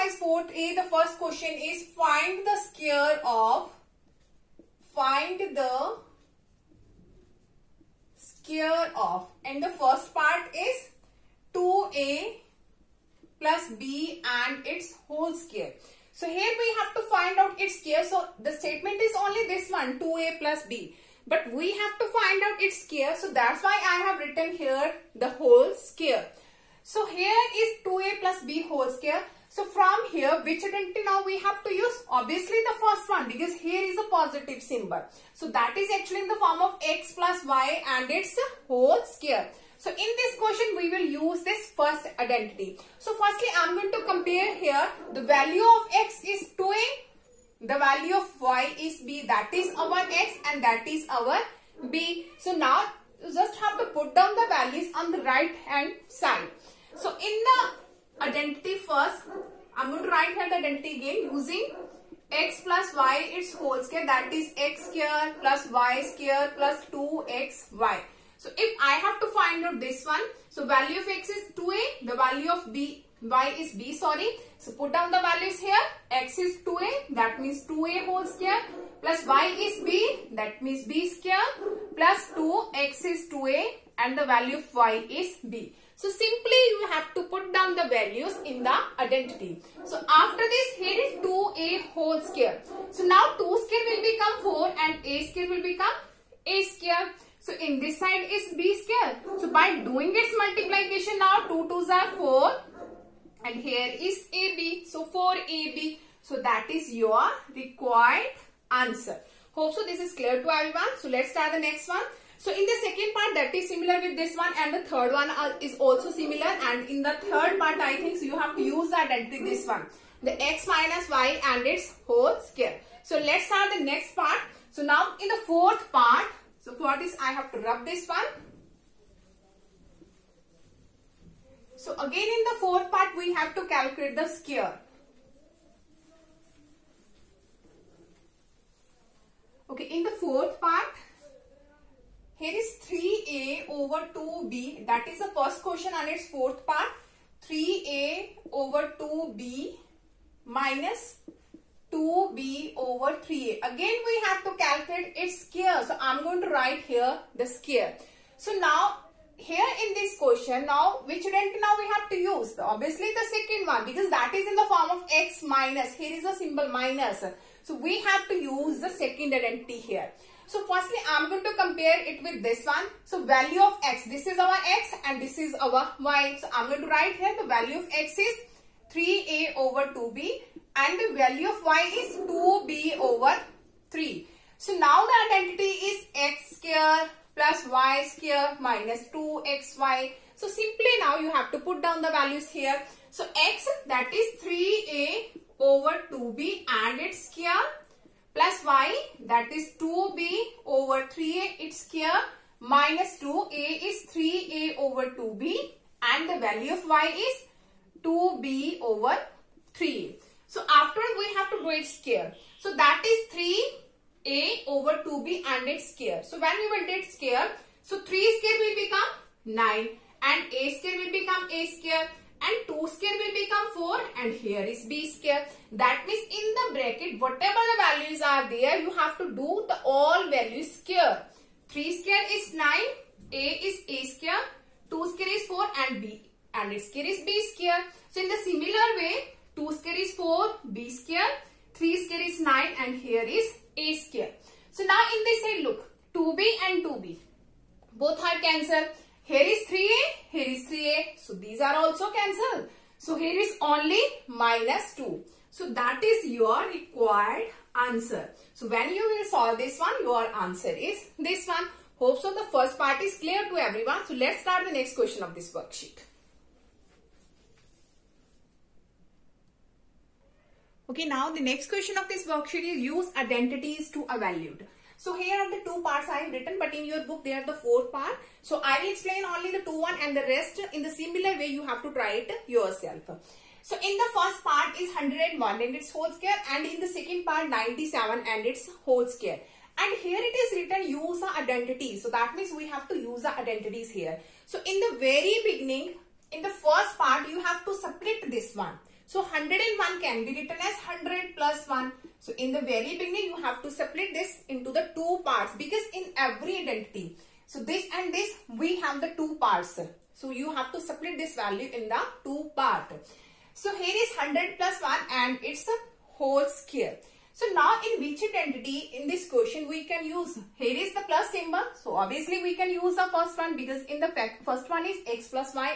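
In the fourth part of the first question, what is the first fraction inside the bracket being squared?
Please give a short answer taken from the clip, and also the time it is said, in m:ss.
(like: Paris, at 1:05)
3a over 2b, at 2:27.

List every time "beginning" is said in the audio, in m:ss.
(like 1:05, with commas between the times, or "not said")
4:55, 5:02.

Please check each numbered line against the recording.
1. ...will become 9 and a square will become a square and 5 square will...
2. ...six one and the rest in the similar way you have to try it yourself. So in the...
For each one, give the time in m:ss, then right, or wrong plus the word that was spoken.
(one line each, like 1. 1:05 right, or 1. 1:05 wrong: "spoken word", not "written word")
1. 3:38 wrong: "2", not "5"
2. 4:39 wrong: "two", not "six".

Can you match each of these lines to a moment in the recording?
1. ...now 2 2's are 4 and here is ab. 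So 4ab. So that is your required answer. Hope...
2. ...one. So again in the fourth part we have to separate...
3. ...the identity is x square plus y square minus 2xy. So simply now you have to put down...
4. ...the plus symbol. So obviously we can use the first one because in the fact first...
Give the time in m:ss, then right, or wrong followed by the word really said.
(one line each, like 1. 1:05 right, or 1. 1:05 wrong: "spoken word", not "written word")
1. 1:41 right
2. 2:08 wrong: "calculate", not "separate"
3. 3:05 right
4. 5:20 right.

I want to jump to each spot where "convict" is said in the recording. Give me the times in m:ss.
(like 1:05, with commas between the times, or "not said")
not said.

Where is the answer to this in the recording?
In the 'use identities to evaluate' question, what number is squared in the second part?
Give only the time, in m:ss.
4:47.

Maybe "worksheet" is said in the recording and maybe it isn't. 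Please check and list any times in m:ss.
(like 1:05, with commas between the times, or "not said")
4:25, 4:32.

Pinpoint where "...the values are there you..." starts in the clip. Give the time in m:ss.
3:47.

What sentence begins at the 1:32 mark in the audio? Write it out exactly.
So now 2 square will become 4 and a square will become a square.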